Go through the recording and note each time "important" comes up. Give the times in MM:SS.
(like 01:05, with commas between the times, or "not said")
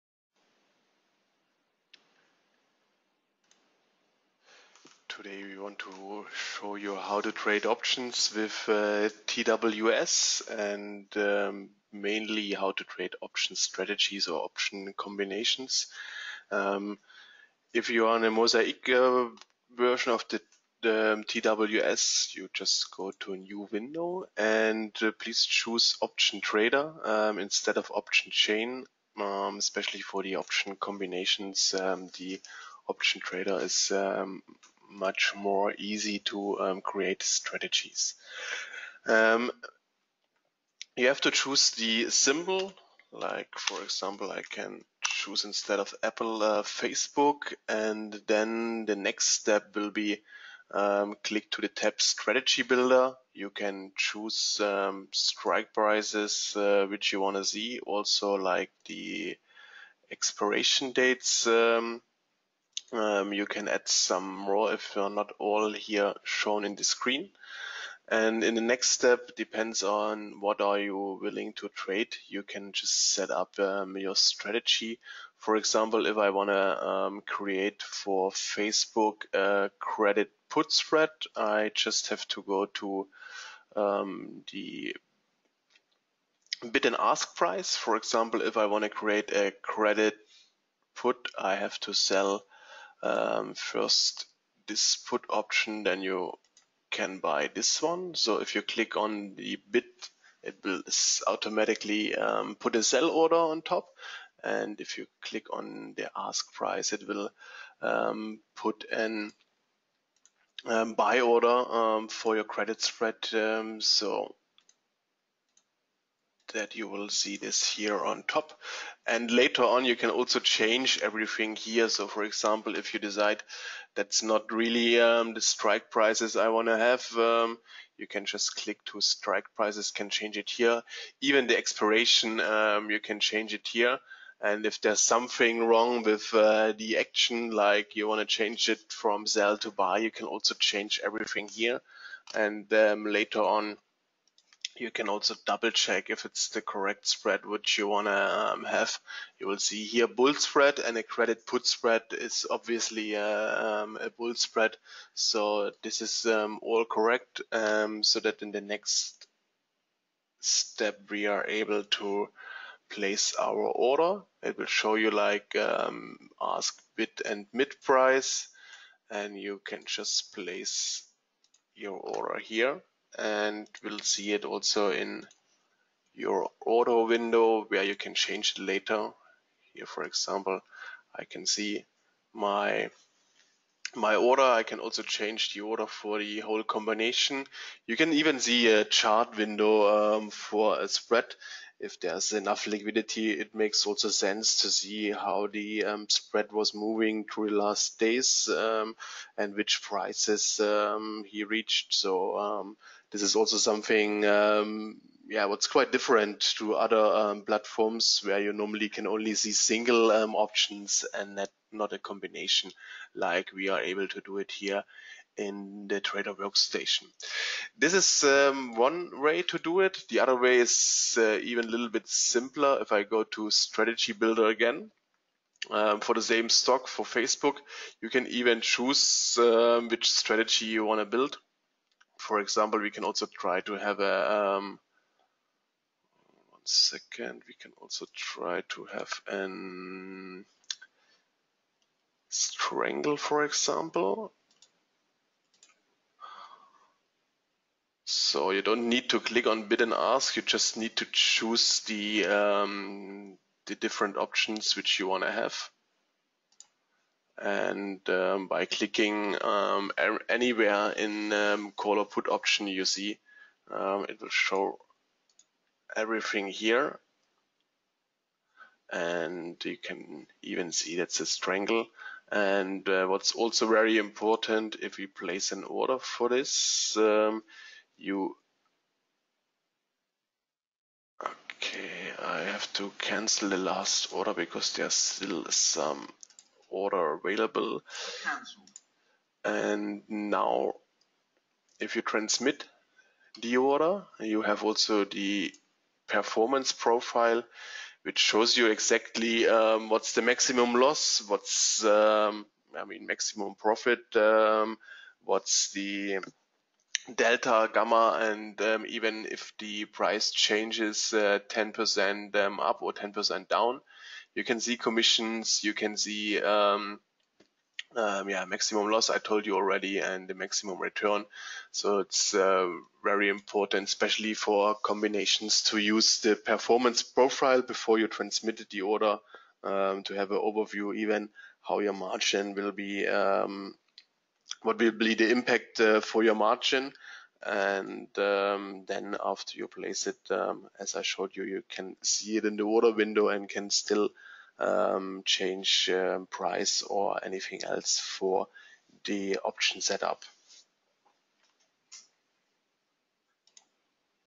04:33, 05:23.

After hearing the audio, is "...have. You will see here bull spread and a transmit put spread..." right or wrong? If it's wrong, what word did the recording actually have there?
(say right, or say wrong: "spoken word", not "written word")
wrong: "credit", not "transmit".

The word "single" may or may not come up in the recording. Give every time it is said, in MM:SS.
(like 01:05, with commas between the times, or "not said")
03:29.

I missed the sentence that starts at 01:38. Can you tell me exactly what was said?
So if you click on the bid, it will automatically um, put a sell order on top.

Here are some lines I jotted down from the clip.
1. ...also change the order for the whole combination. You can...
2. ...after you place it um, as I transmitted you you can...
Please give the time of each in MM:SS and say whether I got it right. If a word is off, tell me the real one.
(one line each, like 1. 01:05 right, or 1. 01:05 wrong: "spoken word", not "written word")
1. 03:04 right
2. 05:39 wrong: "showed", not "transmitted".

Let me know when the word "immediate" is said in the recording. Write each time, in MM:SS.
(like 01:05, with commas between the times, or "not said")
not said.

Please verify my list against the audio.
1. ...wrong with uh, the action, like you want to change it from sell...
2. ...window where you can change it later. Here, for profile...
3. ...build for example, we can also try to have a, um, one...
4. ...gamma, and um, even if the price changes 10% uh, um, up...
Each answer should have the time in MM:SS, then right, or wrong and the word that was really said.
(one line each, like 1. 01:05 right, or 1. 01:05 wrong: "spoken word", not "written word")
1. 02:15 right
2. 02:57 wrong: "example", not "profile"
3. 03:51 right
4. 05:07 right.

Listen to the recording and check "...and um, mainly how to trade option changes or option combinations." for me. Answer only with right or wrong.
wrong.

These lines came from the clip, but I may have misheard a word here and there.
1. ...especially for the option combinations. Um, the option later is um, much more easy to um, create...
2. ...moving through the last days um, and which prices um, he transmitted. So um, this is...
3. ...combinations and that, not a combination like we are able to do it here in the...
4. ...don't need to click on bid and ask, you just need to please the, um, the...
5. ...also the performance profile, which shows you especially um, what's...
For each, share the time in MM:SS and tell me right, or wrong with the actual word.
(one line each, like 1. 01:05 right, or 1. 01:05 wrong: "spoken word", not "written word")
1. 00:29 wrong: "trader", not "later"
2. 03:16 wrong: "reached", not "transmitted"
3. 03:30 wrong: "options", not "combinations"
4. 04:08 wrong: "choose", not "please"
5. 04:54 wrong: "exactly", not "especially".